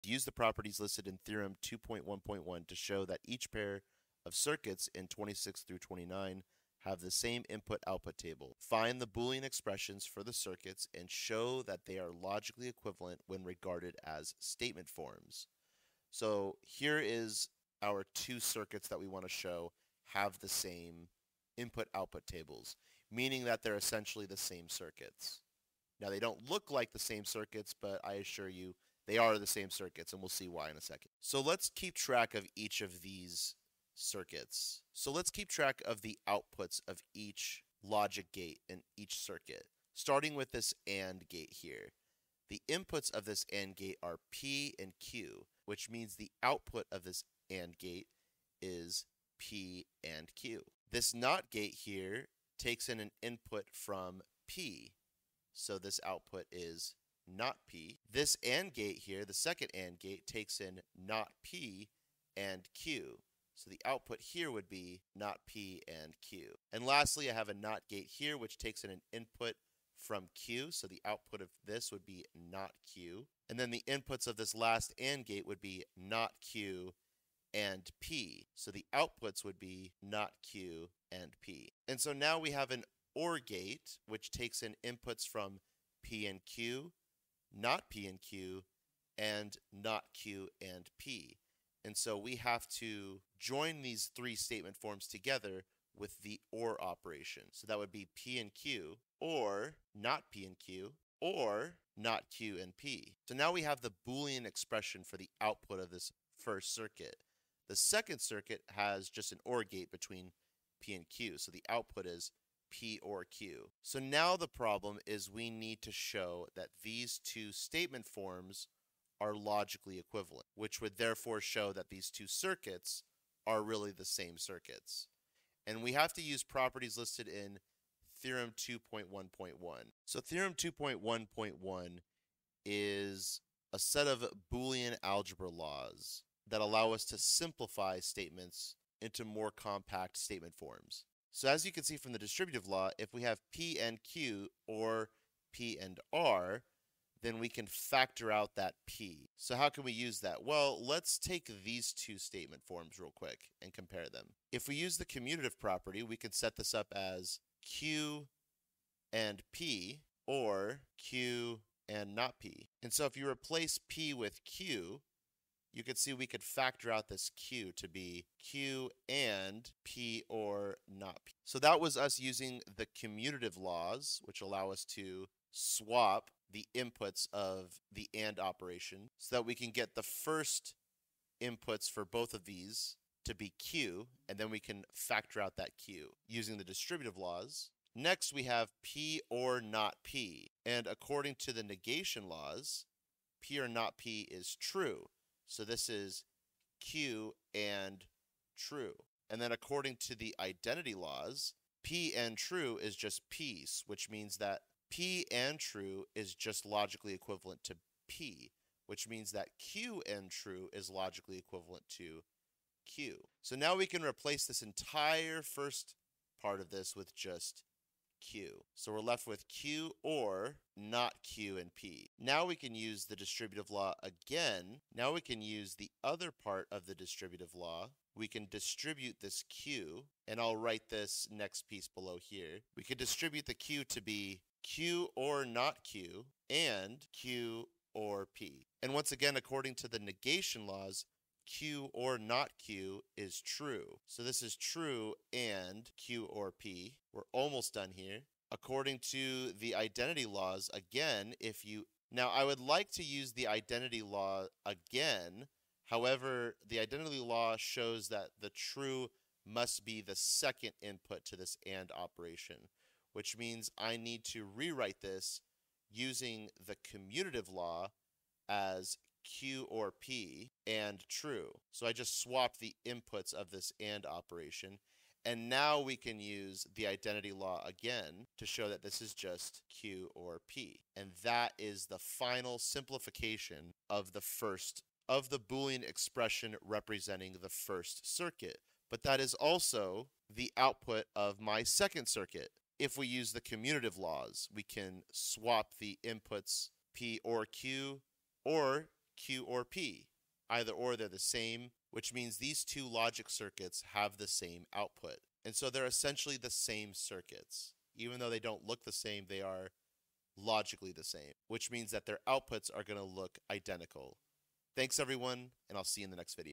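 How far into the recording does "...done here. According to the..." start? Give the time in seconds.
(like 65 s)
247 s.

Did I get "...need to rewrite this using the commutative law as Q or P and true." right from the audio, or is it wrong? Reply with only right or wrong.
right.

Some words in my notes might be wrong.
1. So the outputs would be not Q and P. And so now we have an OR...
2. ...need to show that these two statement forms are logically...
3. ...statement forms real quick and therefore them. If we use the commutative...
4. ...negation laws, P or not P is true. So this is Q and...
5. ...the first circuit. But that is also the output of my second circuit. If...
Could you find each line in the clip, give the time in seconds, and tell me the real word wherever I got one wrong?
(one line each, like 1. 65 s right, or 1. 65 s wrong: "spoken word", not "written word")
1. 78 s right
2. 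115 s right
3. 152 s wrong: "compare", not "therefore"
4. 191 s right
5. 287 s right.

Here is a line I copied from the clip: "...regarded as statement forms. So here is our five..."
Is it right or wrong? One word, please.
wrong.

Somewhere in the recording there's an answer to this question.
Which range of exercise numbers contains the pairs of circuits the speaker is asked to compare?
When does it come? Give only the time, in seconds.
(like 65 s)
5 s.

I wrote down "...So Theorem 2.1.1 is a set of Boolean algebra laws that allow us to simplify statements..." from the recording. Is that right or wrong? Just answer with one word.
right.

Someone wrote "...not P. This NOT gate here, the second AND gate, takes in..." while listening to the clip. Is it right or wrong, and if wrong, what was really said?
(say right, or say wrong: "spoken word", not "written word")
wrong: "AND", not "NOT".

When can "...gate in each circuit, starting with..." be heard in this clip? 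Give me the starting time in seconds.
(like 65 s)
38 s.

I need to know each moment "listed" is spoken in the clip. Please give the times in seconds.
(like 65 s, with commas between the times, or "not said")
0 s, 126 s.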